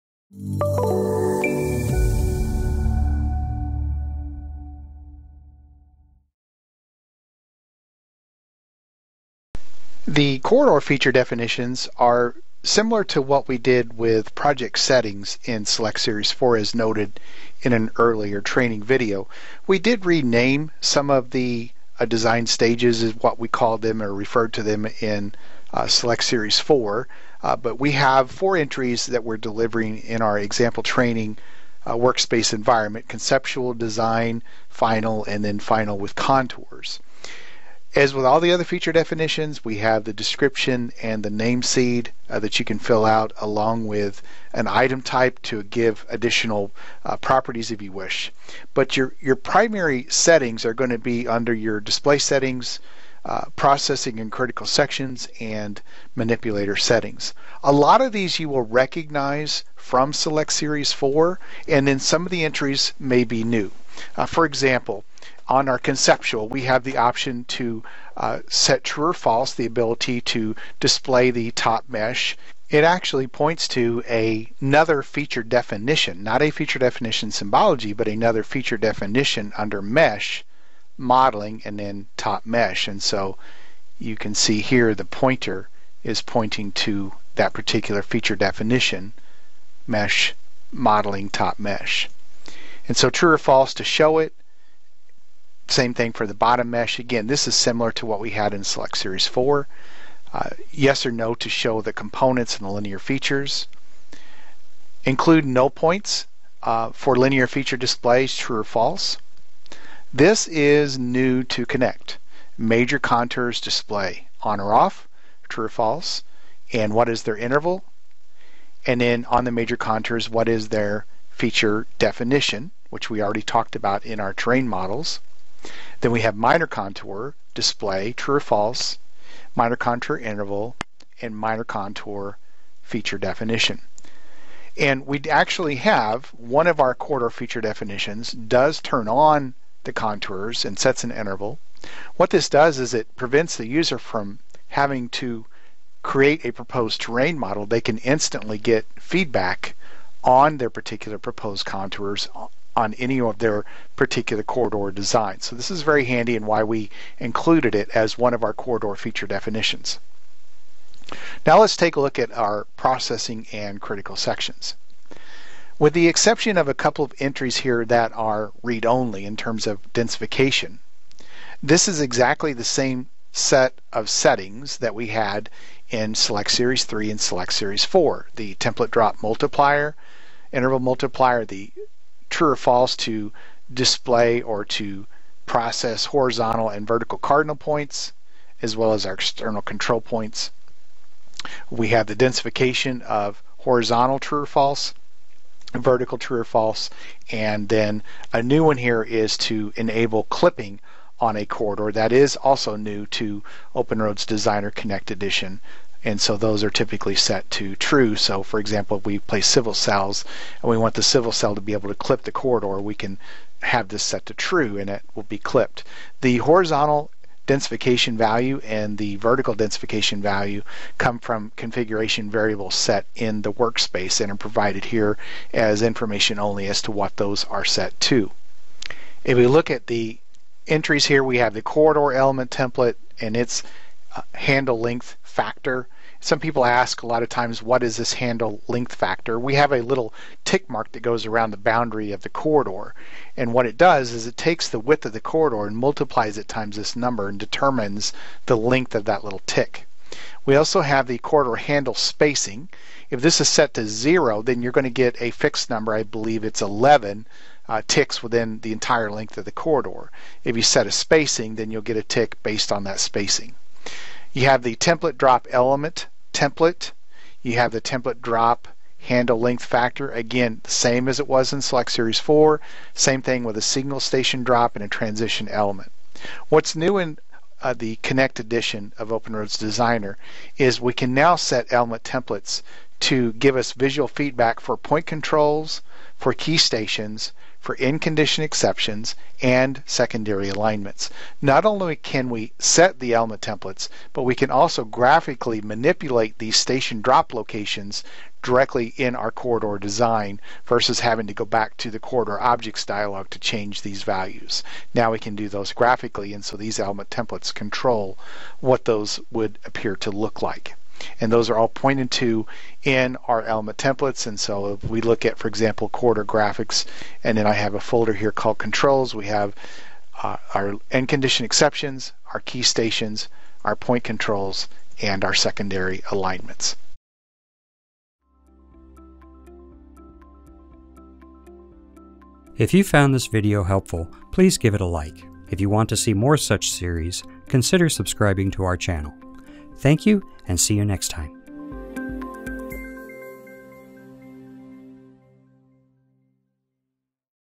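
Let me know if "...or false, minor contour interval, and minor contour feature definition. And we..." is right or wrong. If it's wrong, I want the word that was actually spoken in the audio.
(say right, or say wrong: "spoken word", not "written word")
right.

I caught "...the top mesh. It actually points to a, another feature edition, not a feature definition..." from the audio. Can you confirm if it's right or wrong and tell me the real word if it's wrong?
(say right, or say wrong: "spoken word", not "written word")
wrong: "definition", not "edition".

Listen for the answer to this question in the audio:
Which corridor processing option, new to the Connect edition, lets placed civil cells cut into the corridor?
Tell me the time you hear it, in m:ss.
3:19.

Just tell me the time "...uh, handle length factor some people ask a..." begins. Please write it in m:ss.
3:54.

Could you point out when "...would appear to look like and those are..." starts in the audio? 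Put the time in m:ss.
5:09.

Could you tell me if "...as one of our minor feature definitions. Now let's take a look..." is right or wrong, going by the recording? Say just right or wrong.
wrong.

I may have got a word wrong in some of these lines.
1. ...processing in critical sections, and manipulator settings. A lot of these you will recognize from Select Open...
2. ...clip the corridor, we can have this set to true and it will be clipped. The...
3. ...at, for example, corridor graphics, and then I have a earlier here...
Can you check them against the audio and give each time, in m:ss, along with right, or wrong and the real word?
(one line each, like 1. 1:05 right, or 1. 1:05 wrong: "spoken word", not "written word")
1. 0:53 wrong: "Series", not "Open"
2. 3:31 right
3. 5:15 wrong: "folder", not "earlier".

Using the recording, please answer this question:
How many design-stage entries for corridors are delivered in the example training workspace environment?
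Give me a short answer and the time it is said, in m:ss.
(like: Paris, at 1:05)
4, at 0:28.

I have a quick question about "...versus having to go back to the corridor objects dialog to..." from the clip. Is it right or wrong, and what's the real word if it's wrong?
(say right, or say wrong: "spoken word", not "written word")
right.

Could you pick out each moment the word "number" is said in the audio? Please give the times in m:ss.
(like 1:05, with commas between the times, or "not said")
4:06, 4:15.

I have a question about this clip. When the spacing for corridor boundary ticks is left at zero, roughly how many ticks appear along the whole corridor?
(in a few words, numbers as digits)
11.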